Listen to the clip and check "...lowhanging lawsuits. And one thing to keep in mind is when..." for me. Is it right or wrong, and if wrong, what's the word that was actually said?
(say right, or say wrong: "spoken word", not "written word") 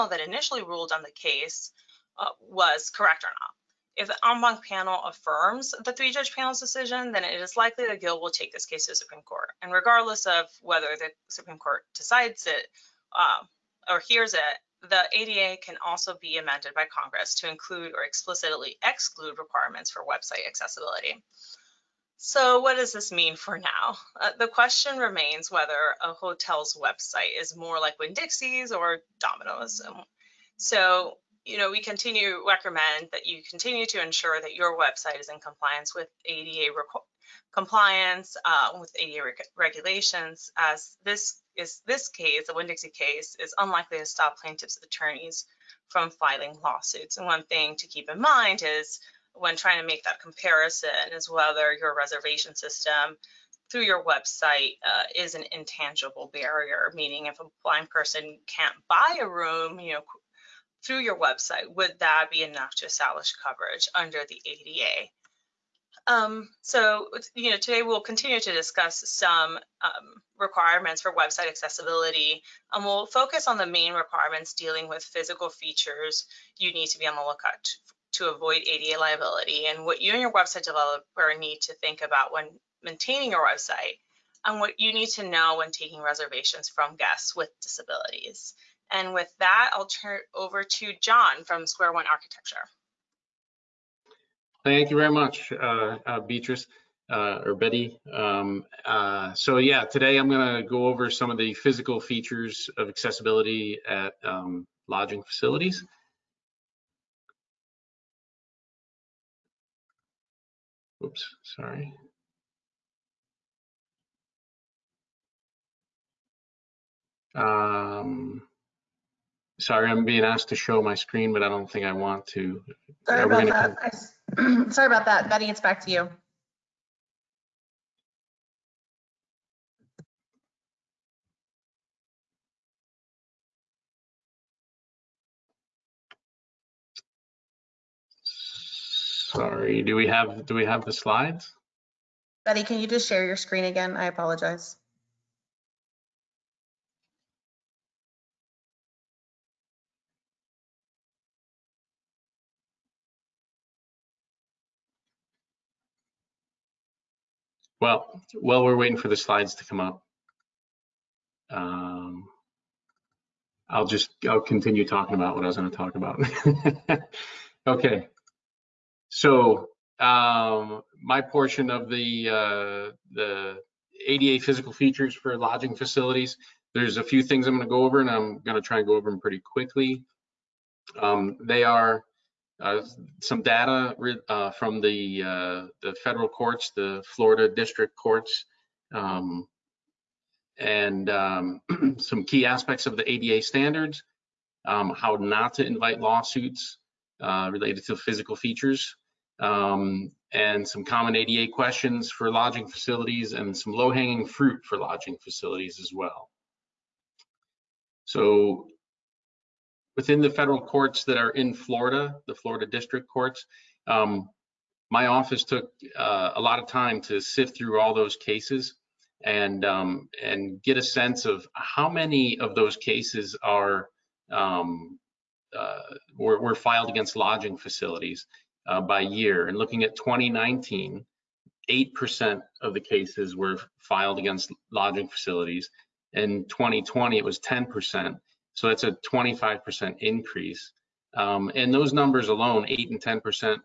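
wrong: "filing", not "lowhanging".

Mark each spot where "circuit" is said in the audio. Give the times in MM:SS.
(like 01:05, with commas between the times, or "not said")
not said.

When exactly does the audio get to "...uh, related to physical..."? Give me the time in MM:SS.
03:17.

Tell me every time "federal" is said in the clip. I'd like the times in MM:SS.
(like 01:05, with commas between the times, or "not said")
03:06, 03:30.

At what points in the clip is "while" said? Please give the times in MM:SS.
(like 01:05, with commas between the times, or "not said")
02:38.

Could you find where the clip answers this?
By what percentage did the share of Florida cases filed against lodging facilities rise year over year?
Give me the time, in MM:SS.
03:59.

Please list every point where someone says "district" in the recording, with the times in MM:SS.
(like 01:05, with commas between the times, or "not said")
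03:07, 03:32.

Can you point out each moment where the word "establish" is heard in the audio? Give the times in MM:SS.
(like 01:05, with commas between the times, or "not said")
01:02.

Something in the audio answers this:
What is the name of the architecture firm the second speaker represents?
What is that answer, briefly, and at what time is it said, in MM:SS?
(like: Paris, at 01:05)
Square One Architecture, at 01:31.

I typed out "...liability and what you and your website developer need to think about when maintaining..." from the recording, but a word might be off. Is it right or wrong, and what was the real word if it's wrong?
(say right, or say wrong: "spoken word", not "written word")
right.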